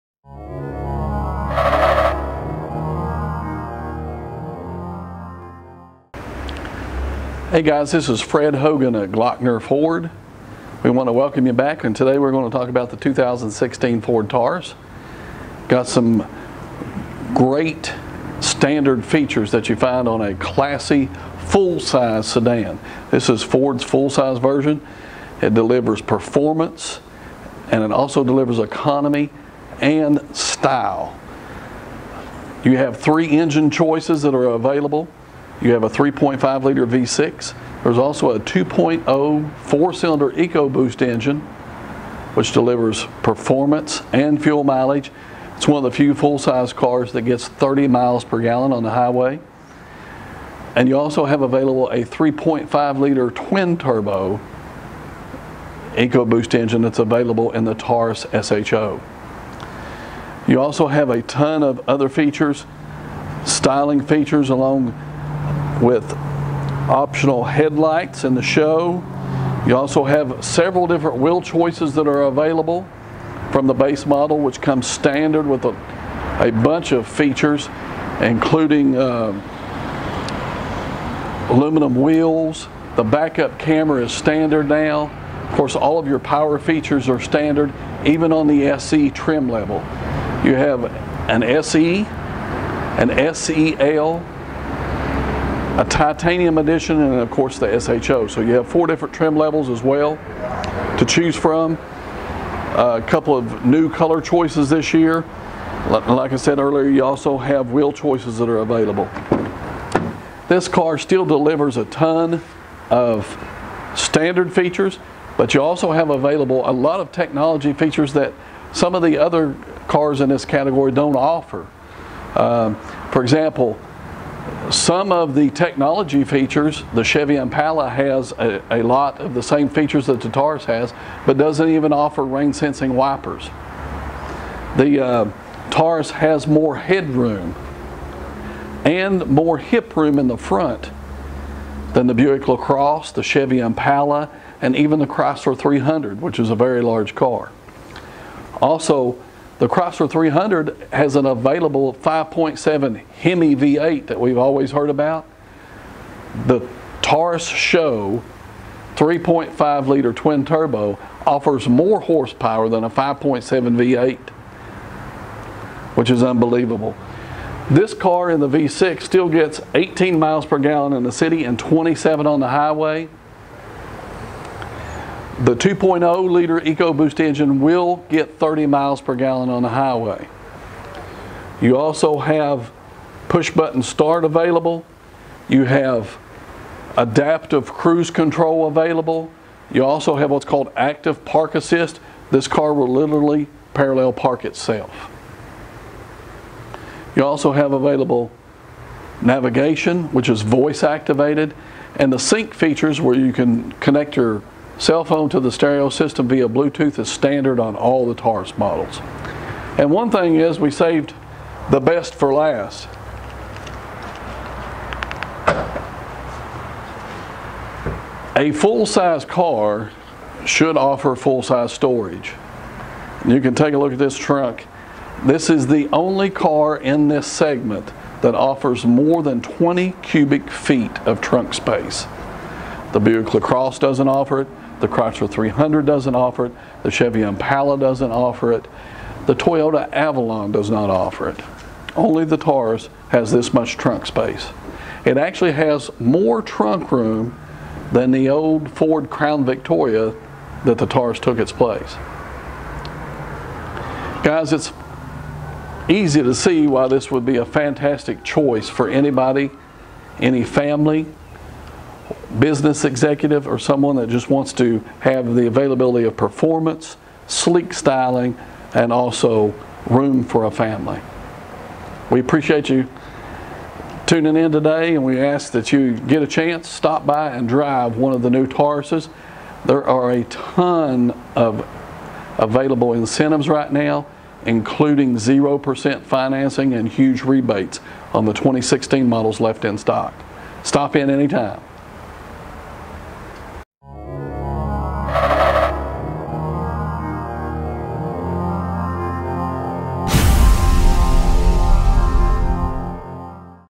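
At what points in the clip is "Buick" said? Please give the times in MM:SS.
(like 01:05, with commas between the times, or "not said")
02:22, 03:52.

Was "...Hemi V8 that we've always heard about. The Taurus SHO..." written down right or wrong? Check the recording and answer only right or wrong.
right.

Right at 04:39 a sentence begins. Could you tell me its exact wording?
There are a ton of available incentives right now, including 0% financing and huge rebates on the 2016 models left in stock.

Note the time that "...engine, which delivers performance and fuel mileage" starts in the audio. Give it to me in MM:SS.
00:41.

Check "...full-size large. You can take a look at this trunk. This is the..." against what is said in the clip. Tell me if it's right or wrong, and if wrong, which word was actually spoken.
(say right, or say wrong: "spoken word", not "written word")
wrong: "storage", not "large".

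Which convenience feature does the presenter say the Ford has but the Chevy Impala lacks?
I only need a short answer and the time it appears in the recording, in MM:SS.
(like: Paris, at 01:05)
rain sensing wipers, at 02:12.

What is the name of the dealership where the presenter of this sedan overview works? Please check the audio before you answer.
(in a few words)
Glockner Ford.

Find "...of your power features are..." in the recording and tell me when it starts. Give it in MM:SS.
01:25.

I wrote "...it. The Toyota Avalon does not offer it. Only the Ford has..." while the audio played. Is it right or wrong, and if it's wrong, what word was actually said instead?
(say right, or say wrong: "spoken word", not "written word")
wrong: "Taurus", not "Ford".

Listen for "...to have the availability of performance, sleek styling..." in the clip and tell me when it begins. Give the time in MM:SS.
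04:24.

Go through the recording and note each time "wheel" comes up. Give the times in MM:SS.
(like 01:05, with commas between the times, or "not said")
01:11, 01:22, 01:47.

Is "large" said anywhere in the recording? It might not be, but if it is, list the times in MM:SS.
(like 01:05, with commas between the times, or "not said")
02:26.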